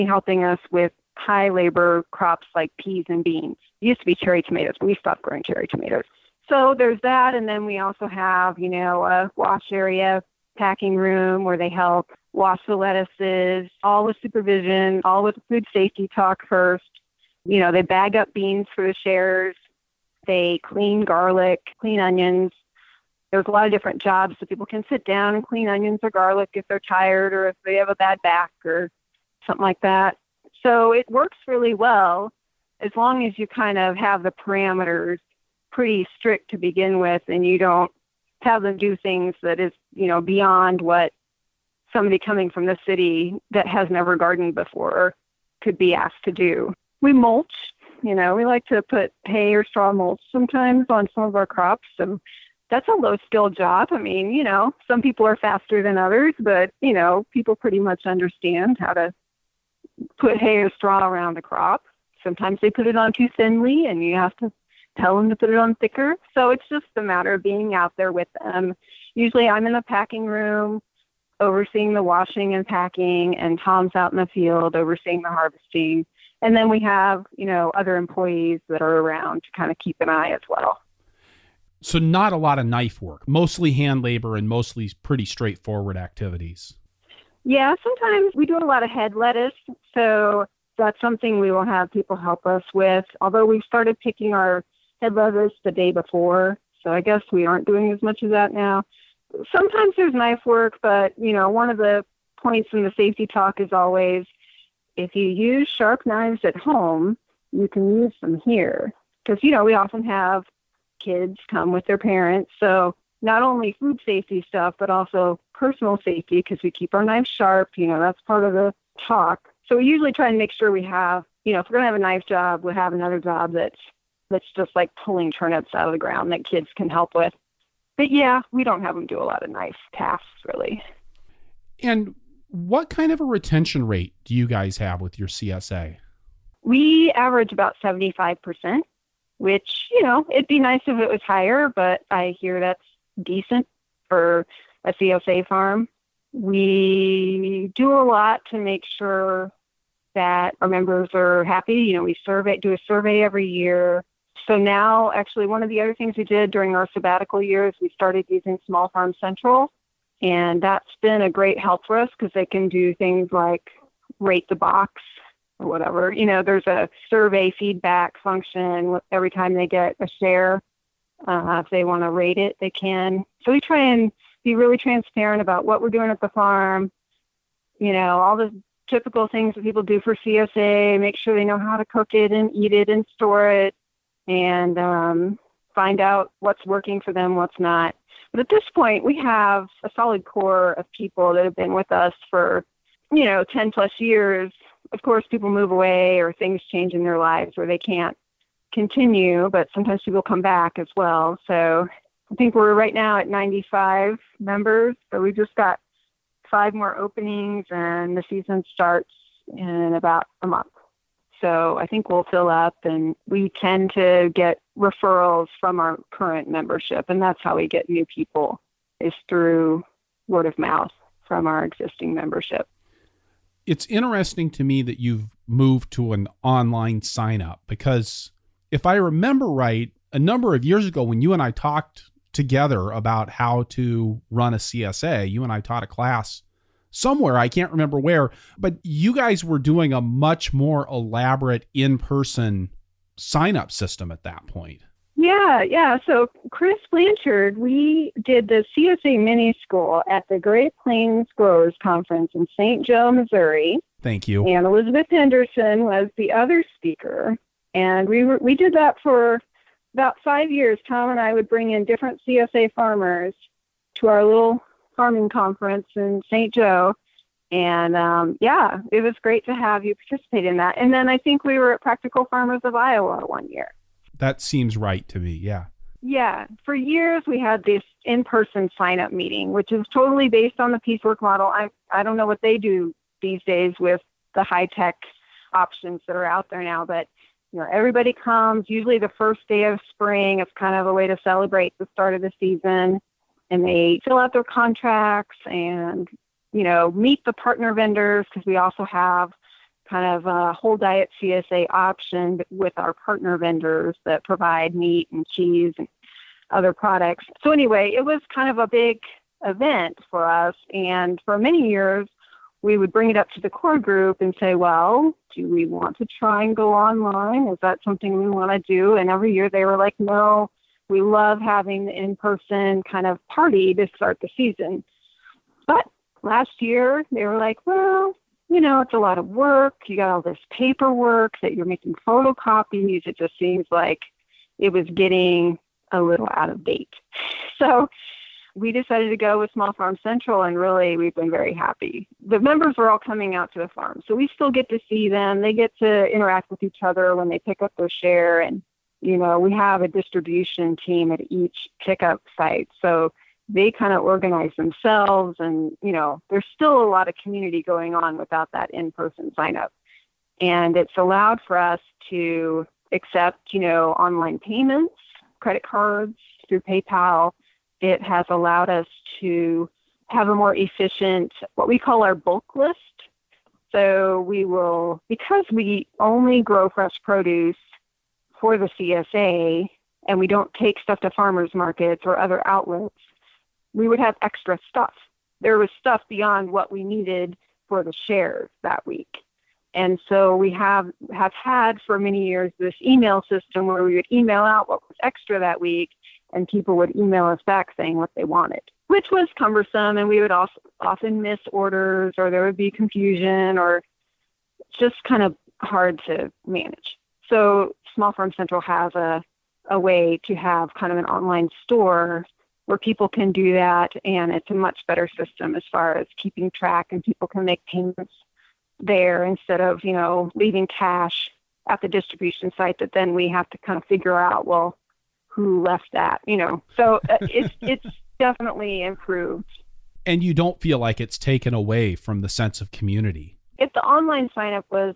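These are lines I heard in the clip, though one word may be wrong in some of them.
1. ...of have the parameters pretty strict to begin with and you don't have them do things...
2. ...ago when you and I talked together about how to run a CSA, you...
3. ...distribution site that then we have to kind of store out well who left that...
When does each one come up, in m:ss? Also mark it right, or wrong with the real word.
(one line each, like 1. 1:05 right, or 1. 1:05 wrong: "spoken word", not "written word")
1. 0:33 right
2. 3:50 right
3. 7:01 wrong: "figure", not "store".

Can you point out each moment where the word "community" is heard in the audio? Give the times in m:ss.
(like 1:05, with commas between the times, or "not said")
5:57, 7:12.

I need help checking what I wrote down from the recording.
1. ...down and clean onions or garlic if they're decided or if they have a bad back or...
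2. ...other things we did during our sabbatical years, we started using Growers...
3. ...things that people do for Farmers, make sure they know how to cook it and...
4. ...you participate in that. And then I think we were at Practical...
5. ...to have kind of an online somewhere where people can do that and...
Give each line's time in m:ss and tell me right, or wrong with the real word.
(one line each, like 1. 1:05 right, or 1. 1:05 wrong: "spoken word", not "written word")
1. 0:25 wrong: "tired", not "decided"
2. 2:35 wrong: "Small", not "Growers"
3. 2:59 wrong: "CSA", not "Farmers"
4. 4:29 right
5. 6:50 wrong: "store", not "somewhere".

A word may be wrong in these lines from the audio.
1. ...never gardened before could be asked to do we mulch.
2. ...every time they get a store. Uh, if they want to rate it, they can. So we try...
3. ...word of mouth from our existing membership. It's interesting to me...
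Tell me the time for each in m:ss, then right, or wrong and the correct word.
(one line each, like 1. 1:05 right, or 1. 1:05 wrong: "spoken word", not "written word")
1. 0:43 right
2. 2:49 wrong: "share", not "store"
3. 3:40 right.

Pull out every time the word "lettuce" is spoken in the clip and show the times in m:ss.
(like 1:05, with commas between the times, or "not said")
0:12, 1:29, 1:35.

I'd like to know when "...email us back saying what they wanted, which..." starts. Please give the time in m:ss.
6:36.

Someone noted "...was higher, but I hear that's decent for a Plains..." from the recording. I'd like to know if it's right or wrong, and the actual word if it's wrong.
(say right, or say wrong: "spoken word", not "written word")
wrong: "CSA", not "Plains".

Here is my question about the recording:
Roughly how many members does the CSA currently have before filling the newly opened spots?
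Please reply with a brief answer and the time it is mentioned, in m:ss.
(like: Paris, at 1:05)
95, at 3:23.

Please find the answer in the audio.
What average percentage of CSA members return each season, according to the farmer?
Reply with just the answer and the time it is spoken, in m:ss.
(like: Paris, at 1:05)
75%, at 2:17.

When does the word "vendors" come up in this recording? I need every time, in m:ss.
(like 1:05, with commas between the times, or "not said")
4:57, 5:03.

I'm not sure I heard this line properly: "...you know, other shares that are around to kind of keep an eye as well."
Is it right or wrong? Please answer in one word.
wrong.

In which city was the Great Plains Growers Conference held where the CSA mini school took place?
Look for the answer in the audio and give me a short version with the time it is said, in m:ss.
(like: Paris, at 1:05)
St. Joe, Missouri, at 4:12.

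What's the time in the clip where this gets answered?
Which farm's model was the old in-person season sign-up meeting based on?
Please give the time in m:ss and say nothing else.
4:40.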